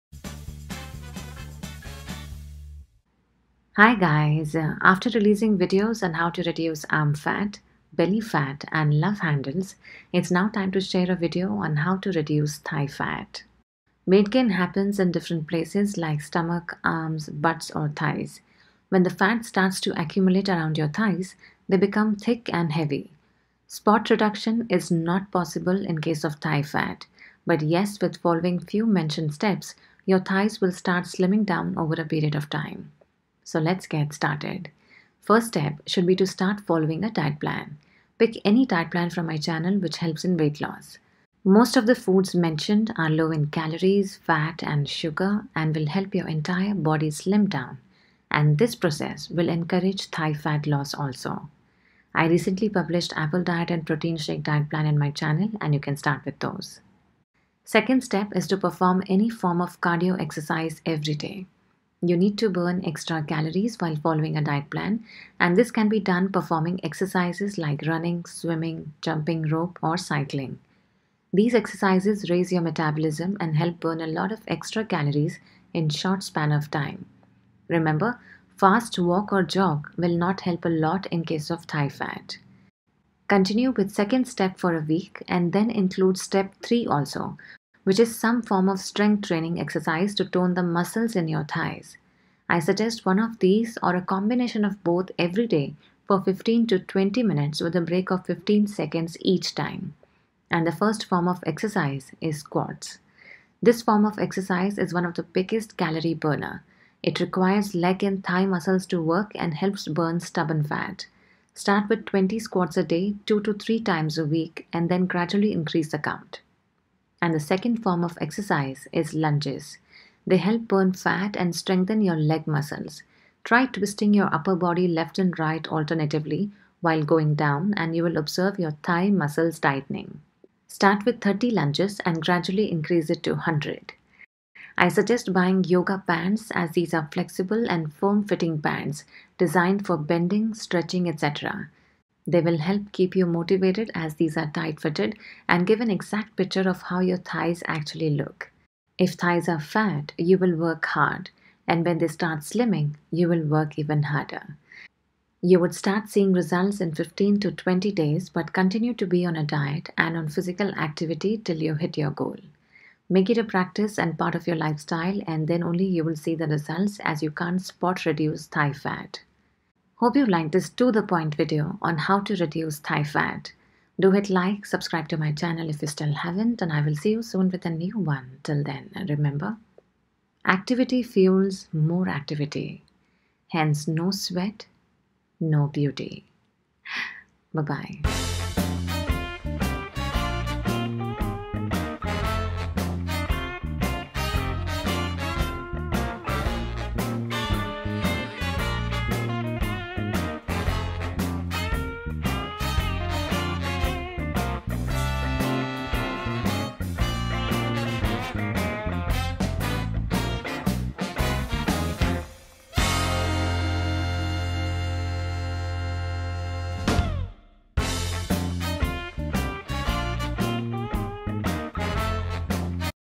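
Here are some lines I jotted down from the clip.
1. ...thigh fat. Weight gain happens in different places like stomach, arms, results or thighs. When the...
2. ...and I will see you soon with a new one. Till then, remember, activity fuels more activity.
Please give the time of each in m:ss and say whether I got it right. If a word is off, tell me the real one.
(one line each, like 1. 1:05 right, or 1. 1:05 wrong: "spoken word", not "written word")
1. 0:12 wrong: "butts", not "results"
2. 2:56 right.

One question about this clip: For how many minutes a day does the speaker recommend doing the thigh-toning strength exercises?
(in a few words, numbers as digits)
15 to 20 minutes.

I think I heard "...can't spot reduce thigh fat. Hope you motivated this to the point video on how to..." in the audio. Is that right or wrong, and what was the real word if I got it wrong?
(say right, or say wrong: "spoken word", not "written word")
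wrong: "liked", not "motivated".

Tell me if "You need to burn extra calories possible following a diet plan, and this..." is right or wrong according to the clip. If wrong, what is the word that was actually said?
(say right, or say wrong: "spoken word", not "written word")
wrong: "while", not "possible".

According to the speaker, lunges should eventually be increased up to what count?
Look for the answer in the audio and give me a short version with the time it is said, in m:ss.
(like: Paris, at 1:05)
100, at 2:13.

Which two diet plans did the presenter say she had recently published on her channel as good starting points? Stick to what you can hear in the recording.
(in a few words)
apple diet and protein shake diet.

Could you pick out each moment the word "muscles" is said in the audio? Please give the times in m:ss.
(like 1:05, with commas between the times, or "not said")
1:30, 1:48, 2:02, 2:09.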